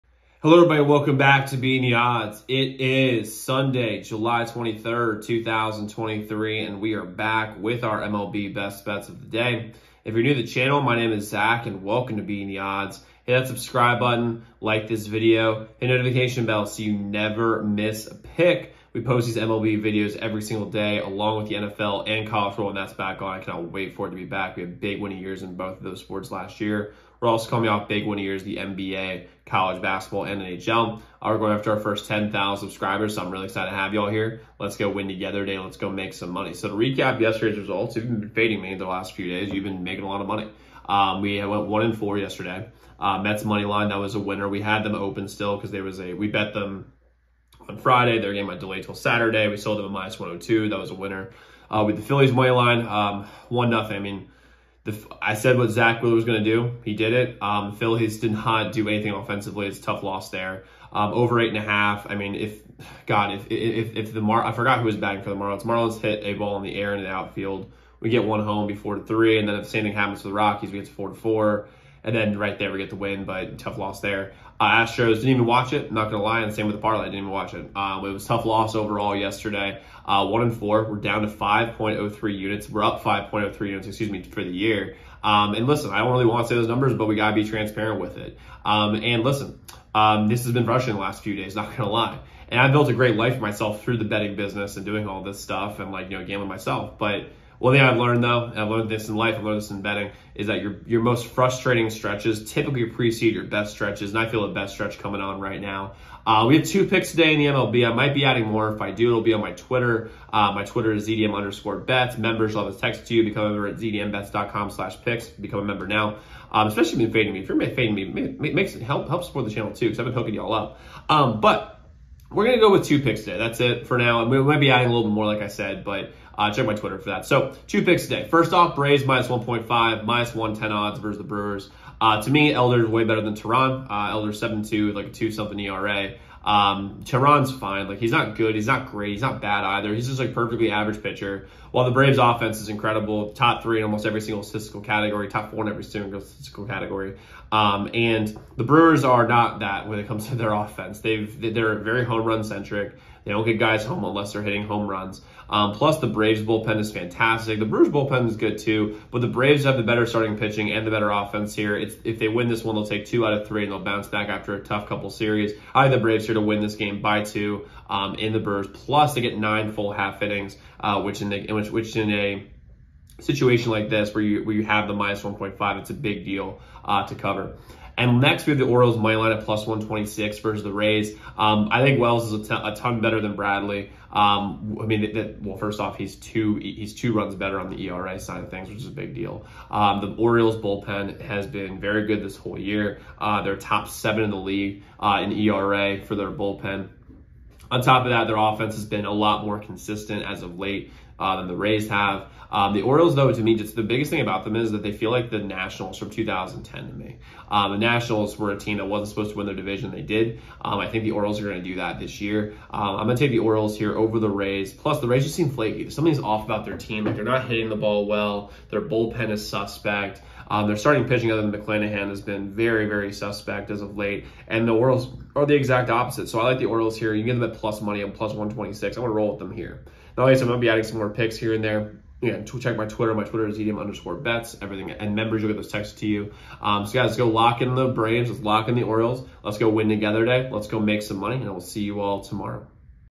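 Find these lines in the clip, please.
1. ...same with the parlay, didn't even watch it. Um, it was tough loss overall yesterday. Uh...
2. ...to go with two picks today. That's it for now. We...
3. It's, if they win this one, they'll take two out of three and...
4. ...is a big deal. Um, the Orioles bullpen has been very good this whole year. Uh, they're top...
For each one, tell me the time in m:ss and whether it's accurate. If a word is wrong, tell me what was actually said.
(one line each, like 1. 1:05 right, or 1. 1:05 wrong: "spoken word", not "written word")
1. 1:16 right
2. 2:02 right
3. 2:41 right
4. 3:08 right.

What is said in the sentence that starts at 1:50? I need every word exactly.
Uh, my Twitter is ZDM underscore bets.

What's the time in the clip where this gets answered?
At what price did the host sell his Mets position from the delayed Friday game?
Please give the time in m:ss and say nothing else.
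0:49.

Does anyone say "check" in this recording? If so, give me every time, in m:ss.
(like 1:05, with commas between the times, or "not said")
2:06, 3:52.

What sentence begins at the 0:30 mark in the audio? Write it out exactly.
Uh, we're going after our first 10,000 subscribers, so I'm really excited to have y'all here.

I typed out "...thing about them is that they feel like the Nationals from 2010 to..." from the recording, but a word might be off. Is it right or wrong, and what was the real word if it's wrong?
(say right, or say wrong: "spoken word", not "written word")
right.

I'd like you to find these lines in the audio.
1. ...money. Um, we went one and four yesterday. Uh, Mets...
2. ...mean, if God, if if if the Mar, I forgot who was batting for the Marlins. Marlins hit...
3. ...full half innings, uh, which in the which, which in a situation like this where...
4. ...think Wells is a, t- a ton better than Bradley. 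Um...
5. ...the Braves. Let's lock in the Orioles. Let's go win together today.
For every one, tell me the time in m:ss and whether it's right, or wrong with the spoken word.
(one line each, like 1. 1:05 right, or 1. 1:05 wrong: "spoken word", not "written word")
1. 0:40 right
2. 1:02 right
3. 2:49 right
4. 3:01 right
5. 3:57 right.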